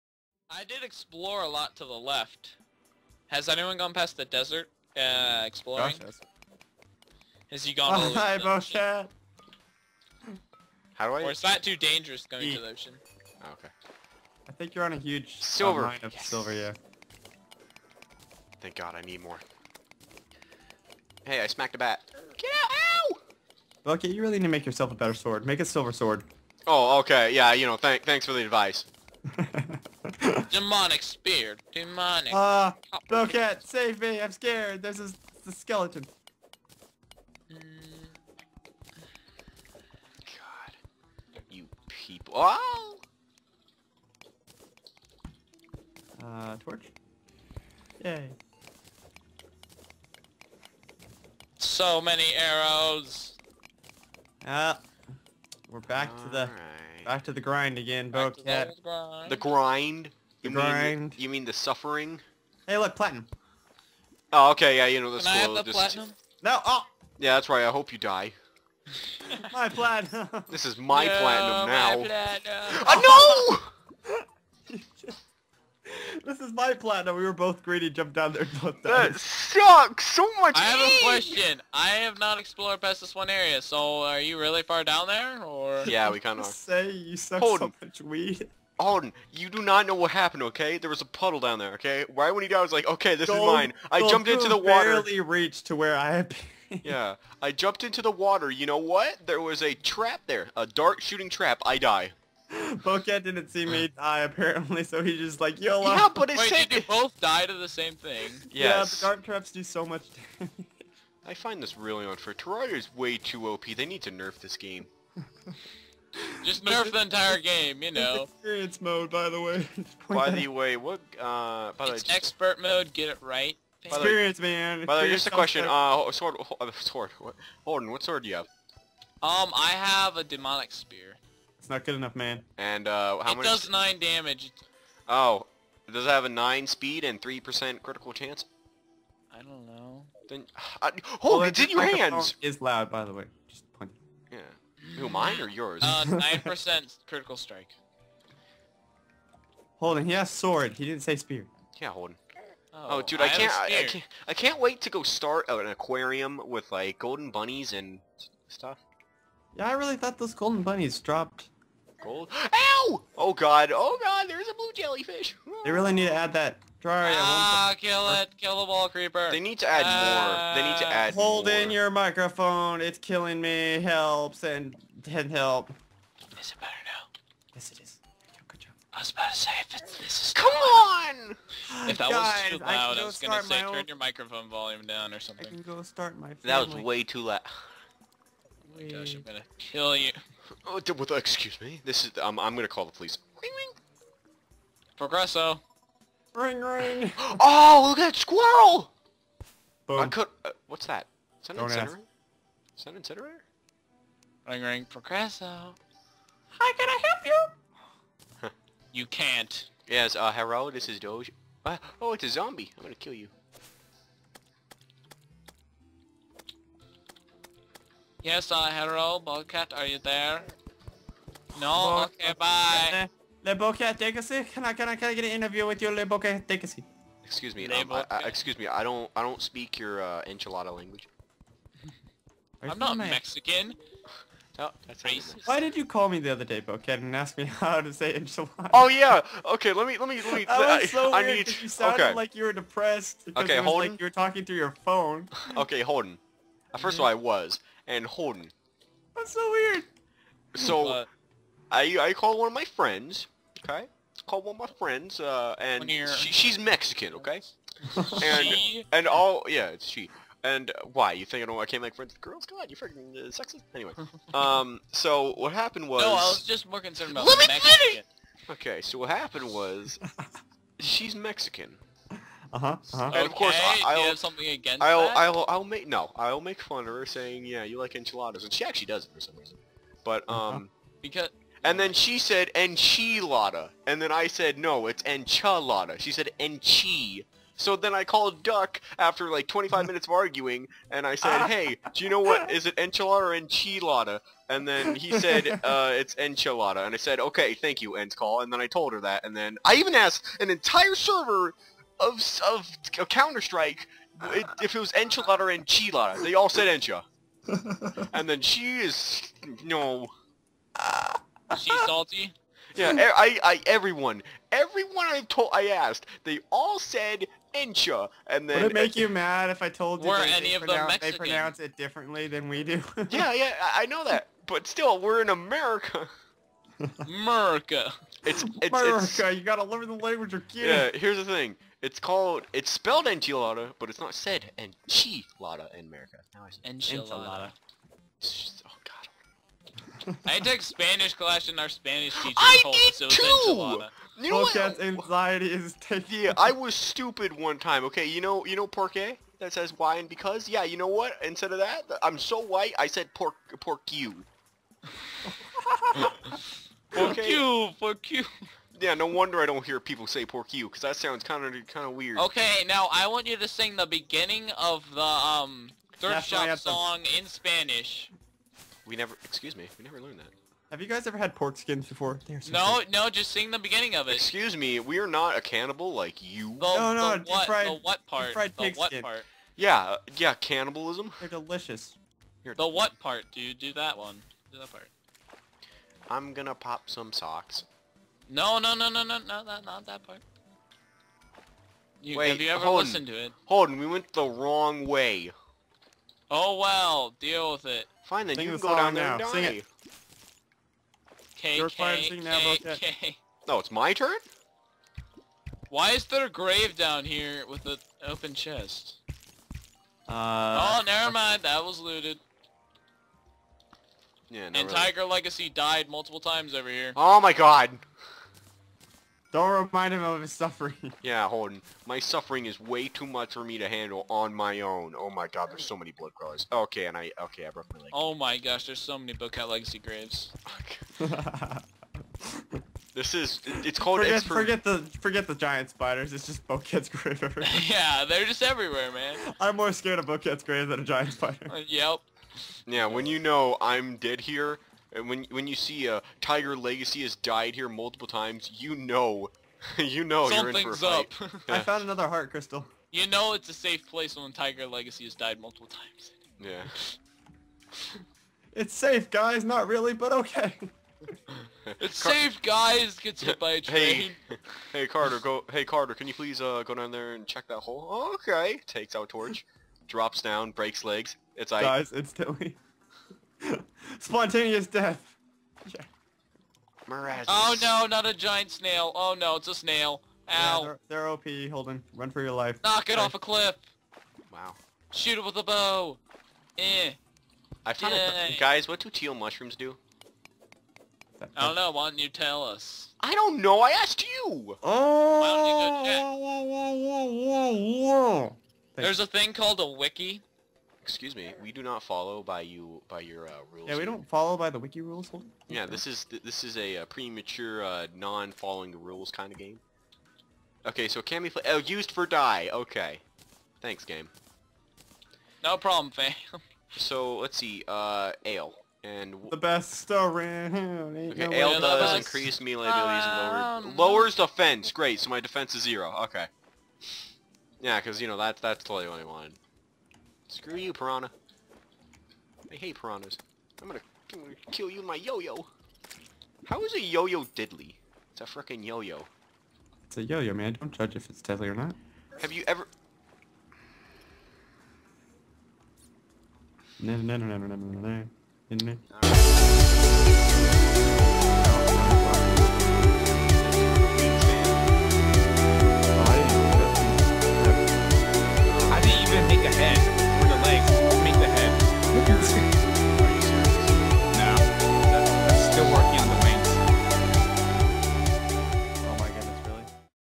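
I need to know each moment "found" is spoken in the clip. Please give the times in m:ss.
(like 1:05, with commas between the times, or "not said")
7:31, 8:07.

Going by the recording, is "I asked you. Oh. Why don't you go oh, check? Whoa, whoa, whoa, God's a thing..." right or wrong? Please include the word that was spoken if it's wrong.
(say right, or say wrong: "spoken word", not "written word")
wrong: "There", not "God".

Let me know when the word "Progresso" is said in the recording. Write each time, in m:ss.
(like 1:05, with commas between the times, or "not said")
3:14, 3:24.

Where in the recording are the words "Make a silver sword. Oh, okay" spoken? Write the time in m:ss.
0:25.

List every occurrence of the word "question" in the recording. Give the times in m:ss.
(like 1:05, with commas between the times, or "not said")
1:21, 2:05.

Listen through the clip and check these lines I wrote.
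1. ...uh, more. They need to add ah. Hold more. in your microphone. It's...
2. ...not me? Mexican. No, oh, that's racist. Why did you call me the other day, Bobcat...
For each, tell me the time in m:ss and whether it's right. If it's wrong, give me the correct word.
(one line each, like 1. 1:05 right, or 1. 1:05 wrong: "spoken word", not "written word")
1. 2:49 right
2. 3:52 right.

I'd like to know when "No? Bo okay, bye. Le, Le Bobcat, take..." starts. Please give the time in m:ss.
3:41.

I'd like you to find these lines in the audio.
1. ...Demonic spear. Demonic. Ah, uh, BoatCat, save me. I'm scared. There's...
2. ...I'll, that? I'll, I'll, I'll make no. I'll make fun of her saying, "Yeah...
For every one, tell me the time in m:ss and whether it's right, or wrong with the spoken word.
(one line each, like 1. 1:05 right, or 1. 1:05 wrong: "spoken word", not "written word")
1. 0:30 right
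2. 4:34 right.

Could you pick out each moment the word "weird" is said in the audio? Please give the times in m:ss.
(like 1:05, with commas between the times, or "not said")
4:01, 4:09, 6:01.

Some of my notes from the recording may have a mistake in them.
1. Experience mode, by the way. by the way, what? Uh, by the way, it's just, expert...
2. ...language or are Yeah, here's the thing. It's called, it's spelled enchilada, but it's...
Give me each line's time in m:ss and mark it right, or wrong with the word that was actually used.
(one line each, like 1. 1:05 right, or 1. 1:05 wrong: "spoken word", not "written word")
1. 1:58 right
2. 5:29 right.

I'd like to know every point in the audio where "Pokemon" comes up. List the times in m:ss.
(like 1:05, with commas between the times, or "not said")
not said.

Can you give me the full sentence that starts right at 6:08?
We never, excuse me, we never learned that.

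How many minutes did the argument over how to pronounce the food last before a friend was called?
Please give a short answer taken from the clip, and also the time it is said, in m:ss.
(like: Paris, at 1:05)
25, at 4:49.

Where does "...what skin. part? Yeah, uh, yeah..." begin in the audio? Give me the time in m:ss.
6:18.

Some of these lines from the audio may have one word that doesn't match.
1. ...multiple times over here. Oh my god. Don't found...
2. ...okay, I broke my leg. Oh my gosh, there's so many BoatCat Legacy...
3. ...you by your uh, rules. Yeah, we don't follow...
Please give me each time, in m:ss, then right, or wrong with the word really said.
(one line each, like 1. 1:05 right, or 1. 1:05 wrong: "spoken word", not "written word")
1. 6:55 wrong: "remind", not "found"
2. 7:07 right
3. 8:22 right.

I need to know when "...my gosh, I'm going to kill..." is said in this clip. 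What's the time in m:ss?
3:08.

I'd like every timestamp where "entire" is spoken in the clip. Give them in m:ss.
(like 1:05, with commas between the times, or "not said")
1:57, 5:00.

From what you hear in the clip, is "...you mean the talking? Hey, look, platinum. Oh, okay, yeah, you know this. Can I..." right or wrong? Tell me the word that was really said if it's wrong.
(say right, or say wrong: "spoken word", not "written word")
wrong: "suffering", not "talking".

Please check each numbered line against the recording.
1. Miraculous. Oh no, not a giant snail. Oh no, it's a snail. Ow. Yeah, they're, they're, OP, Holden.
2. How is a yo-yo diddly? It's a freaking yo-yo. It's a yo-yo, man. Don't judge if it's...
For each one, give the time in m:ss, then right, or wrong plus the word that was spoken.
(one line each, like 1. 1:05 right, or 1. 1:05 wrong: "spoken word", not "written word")
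1. 7:56 right
2. 8:56 right.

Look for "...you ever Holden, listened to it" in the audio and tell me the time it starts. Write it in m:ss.
6:32.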